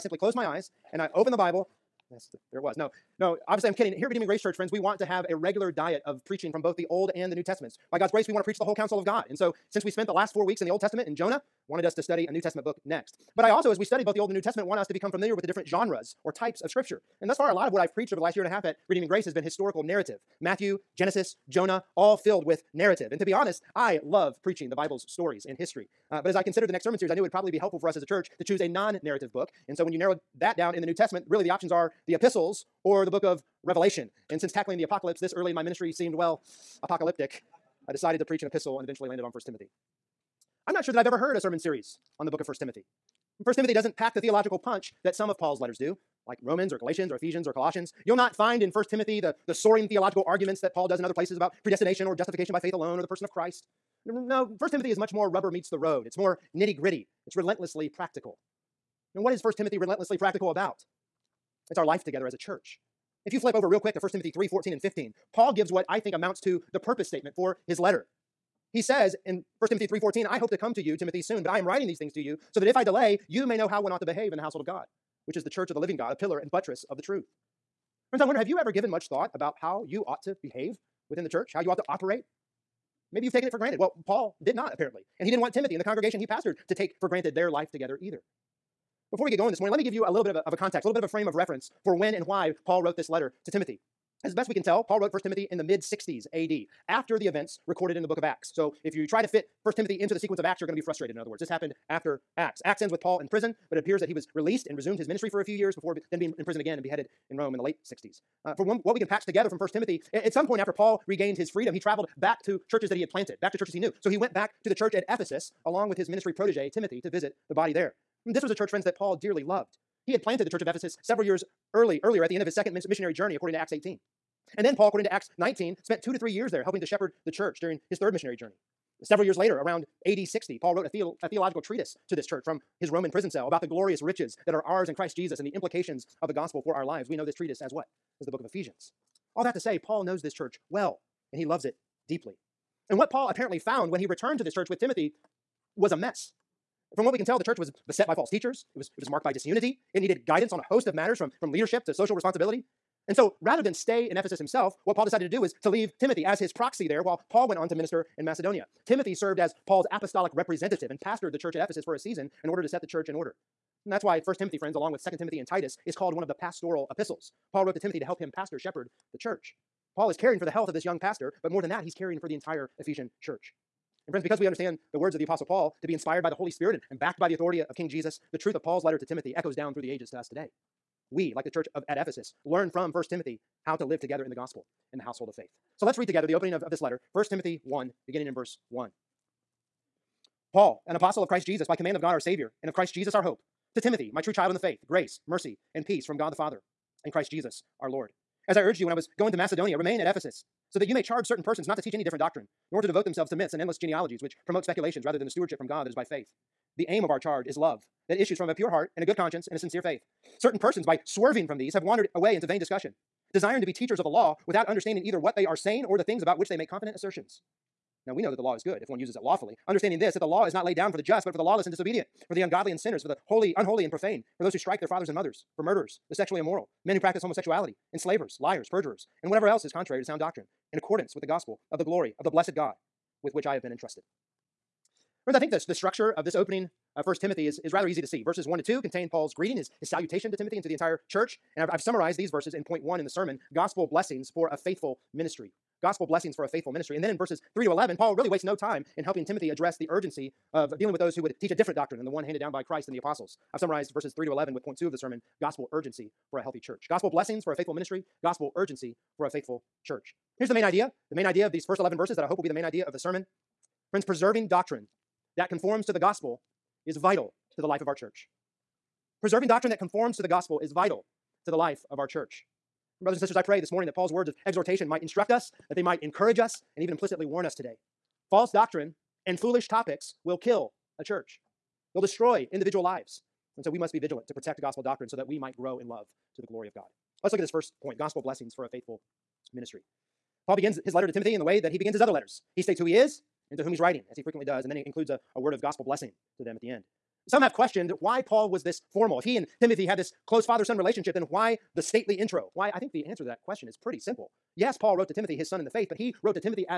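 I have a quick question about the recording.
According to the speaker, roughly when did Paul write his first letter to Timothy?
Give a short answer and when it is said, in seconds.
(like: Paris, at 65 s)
mid 60s AD, at 95 s.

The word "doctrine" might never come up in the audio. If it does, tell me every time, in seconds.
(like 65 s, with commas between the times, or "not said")
202 s, 230 s, 251 s, 264 s, 269 s, 278 s, 284 s.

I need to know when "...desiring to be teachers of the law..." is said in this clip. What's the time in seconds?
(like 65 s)
213 s.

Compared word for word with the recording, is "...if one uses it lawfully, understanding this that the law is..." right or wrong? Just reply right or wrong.
right.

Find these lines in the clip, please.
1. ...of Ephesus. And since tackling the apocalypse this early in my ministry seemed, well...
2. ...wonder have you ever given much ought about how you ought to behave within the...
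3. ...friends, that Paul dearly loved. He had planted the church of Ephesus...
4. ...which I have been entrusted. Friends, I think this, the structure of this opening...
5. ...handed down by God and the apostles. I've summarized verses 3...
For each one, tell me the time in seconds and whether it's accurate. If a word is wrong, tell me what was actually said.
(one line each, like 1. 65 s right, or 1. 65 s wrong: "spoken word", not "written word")
1. 33 s wrong: "Revelation", not "Ephesus"
2. 78 s wrong: "thought", not "ought"
3. 118 s right
4. 233 s right
5. 252 s wrong: "Christ", not "God".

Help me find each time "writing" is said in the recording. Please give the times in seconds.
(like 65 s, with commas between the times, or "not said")
71 s, 293 s.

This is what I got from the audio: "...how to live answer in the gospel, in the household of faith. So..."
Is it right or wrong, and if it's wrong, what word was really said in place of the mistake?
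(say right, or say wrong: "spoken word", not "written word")
wrong: "together", not "answer".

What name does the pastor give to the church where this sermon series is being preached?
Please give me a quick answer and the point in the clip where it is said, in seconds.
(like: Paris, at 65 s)
Redeeming Grace Church, at 4 s.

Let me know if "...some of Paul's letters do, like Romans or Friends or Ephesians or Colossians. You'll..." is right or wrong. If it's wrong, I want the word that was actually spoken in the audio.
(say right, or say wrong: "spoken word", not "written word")
wrong: "Galatians", not "Friends".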